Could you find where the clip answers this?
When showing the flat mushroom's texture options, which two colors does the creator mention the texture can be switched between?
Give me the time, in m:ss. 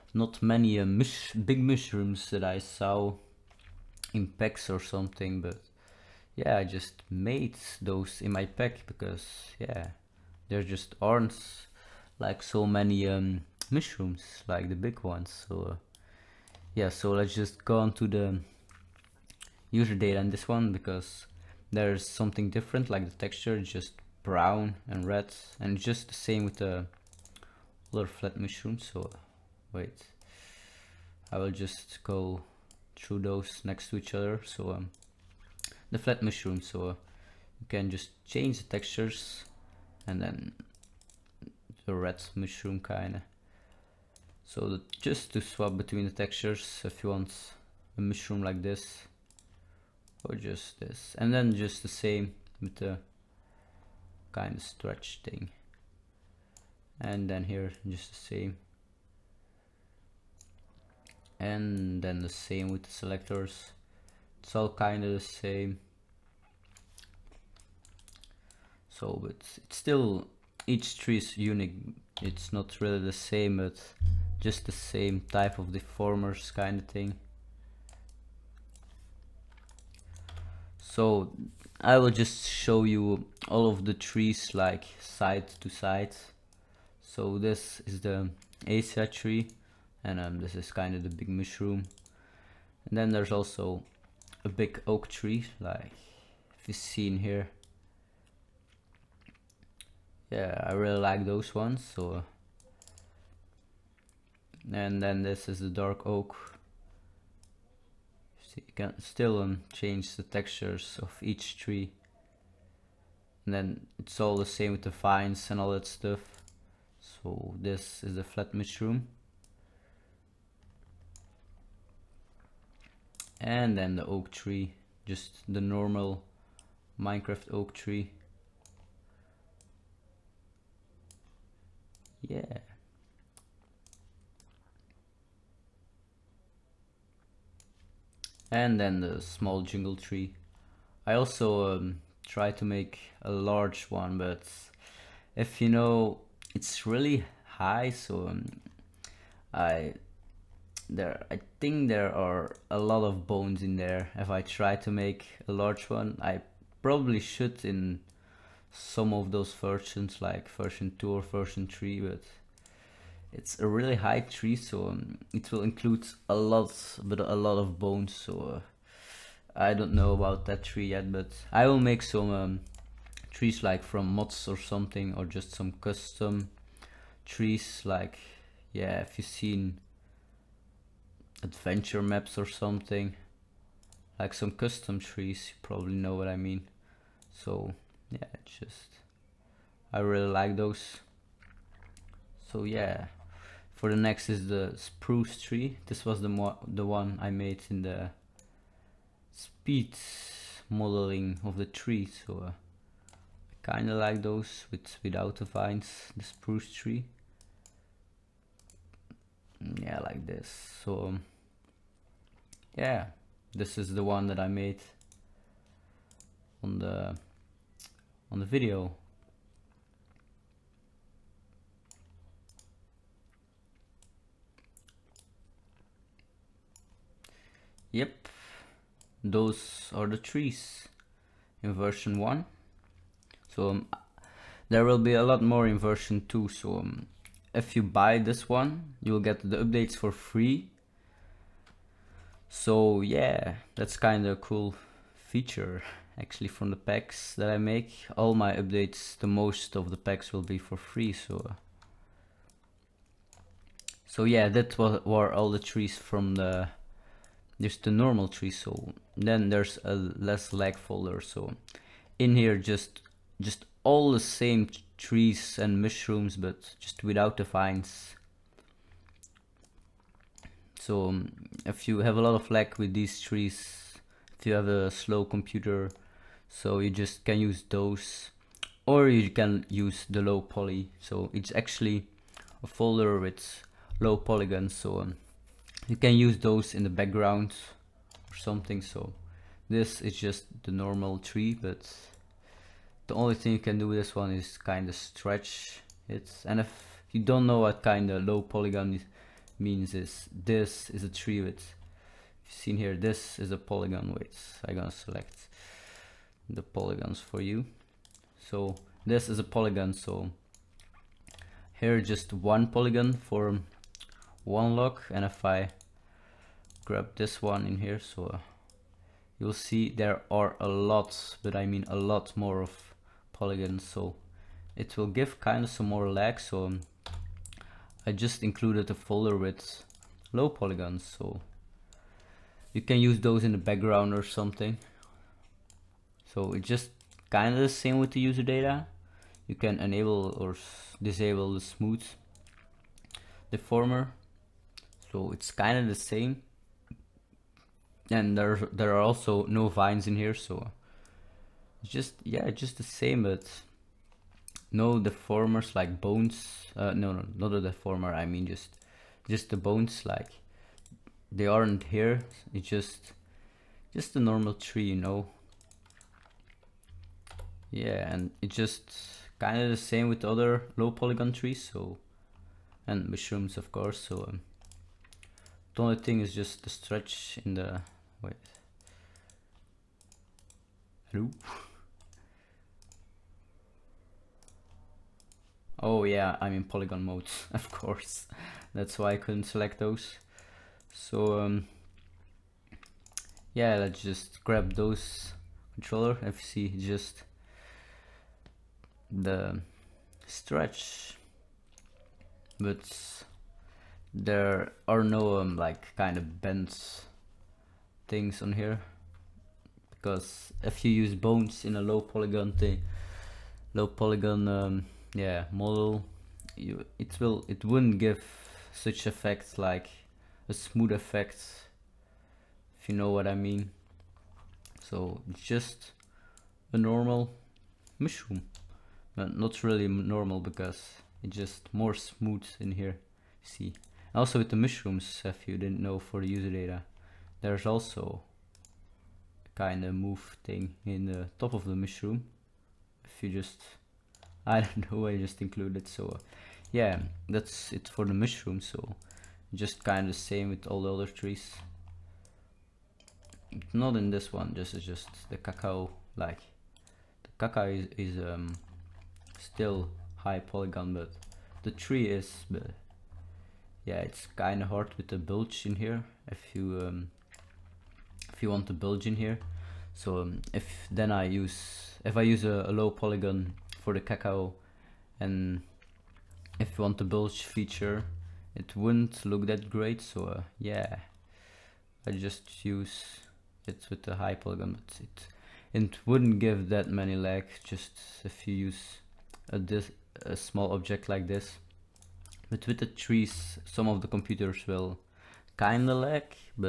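0:24.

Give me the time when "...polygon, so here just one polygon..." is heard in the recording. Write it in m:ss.
5:09.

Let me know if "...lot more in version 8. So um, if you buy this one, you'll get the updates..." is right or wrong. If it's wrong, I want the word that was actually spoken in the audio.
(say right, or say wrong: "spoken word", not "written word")
wrong: "2", not "8".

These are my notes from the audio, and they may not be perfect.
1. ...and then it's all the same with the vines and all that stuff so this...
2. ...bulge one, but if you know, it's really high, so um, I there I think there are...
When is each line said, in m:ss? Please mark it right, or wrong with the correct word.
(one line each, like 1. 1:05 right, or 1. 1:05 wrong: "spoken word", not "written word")
1. 1:53 right
2. 2:23 wrong: "large", not "bulge".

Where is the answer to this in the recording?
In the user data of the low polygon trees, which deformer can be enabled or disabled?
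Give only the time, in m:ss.
5:41.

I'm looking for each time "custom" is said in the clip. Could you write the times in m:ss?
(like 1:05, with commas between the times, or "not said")
2:55, 3:04.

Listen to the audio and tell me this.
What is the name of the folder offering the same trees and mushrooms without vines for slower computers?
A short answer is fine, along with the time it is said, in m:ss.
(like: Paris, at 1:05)
less lag, at 4:19.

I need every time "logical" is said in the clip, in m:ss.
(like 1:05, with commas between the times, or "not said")
not said.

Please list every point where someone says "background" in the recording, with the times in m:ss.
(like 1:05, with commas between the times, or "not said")
4:46, 5:33.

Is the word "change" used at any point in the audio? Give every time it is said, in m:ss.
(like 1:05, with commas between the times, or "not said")
0:38, 1:49.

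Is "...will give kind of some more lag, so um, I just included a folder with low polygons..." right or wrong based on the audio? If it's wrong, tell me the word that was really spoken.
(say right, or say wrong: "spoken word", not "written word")
right.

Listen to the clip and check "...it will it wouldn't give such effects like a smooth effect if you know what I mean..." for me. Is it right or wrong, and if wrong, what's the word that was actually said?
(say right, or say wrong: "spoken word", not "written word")
right.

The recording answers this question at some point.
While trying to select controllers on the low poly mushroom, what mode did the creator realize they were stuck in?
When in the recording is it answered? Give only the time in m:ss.
6:26.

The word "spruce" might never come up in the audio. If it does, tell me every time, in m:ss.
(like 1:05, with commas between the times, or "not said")
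3:14, 3:26.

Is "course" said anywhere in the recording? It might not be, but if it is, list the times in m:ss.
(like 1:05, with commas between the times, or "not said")
6:13, 6:27.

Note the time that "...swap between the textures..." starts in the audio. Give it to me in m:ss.
0:45.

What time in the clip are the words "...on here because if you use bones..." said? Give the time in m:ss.
6:48.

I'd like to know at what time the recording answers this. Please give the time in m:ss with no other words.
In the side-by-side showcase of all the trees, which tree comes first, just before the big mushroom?
1:28.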